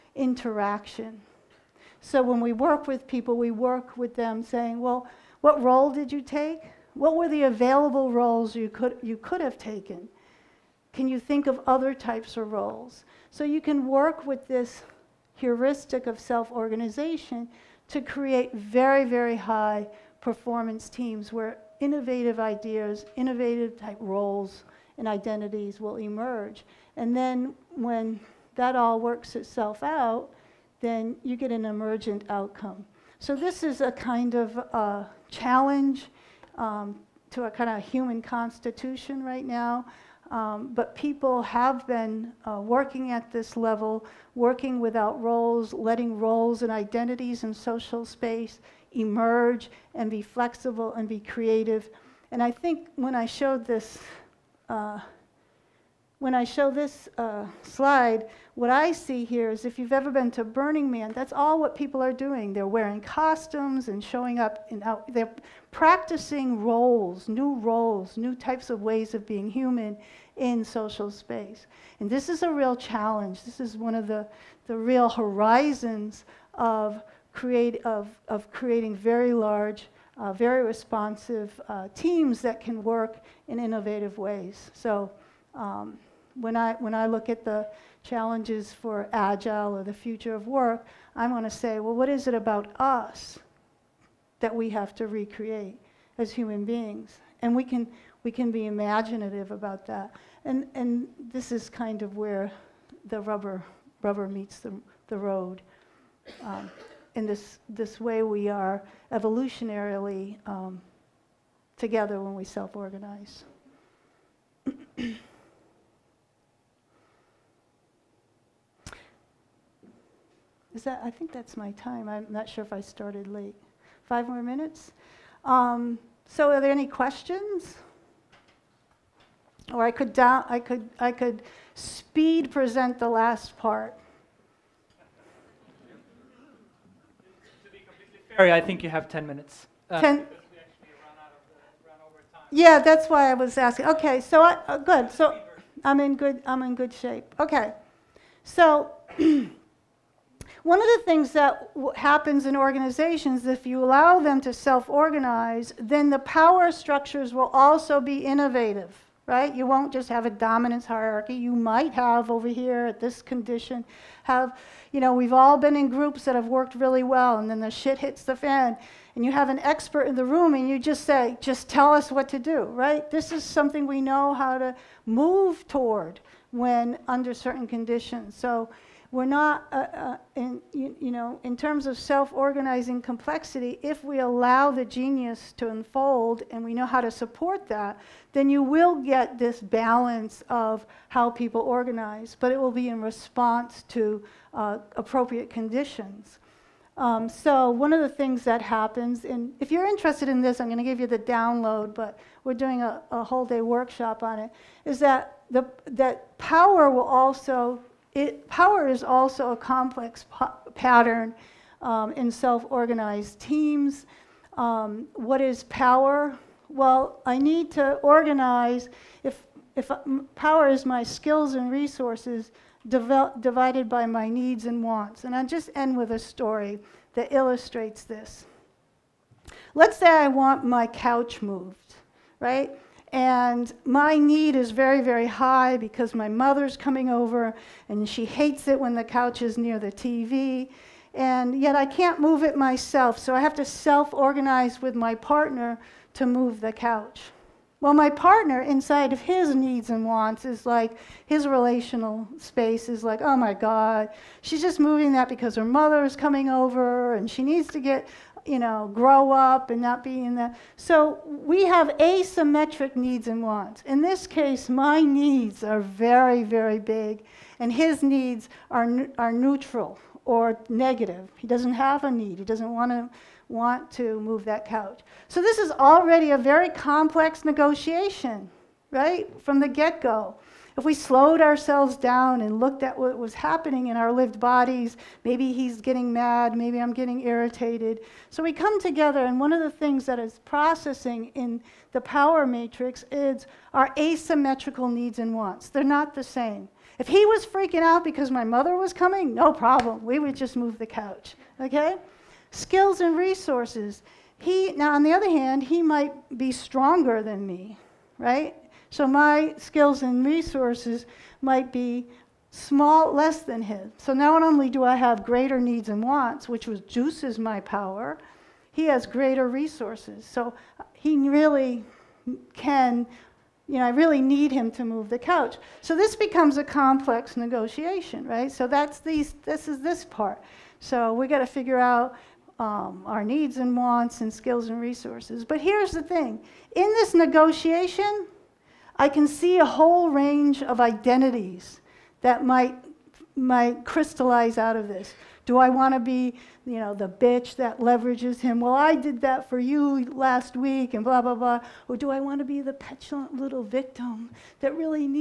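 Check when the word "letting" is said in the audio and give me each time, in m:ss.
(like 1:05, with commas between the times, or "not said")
0:45.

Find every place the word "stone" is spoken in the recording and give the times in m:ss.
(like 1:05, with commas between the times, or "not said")
not said.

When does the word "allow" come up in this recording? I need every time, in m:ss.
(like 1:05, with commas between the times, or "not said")
2:33, 3:04.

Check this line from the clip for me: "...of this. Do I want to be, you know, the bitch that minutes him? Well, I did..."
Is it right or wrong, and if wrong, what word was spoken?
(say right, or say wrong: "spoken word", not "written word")
wrong: "leverages", not "minutes".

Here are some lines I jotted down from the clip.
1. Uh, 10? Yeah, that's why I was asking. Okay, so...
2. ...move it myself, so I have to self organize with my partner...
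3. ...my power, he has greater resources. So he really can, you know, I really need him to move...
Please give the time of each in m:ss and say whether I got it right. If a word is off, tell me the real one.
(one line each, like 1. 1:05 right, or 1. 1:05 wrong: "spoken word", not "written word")
1. 2:19 right
2. 4:02 right
3. 5:17 right.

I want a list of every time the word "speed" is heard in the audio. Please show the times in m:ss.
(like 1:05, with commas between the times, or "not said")
2:11.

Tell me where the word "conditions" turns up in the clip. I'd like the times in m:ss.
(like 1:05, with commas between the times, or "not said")
2:43, 2:57, 3:15.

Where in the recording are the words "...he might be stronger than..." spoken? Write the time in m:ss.
5:05.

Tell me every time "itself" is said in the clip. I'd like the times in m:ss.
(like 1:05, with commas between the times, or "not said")
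0:29.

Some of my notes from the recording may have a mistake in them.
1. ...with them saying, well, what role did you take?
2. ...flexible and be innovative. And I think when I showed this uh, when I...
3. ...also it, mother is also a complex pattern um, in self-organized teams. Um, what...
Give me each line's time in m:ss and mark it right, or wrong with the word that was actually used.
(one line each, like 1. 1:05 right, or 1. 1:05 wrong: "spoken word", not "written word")
1. 0:03 right
2. 0:50 wrong: "creative", not "innovative"
3. 3:27 wrong: "power", not "mother".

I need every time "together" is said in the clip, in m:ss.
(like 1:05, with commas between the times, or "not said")
1:51, 4:48.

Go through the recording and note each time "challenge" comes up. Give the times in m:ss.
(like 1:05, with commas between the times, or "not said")
0:35, 1:12, 1:28.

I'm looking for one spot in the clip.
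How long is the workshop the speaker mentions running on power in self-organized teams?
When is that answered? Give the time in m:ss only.
3:23.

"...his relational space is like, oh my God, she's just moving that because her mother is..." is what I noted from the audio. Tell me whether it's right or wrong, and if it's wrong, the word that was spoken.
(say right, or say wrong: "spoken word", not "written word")
right.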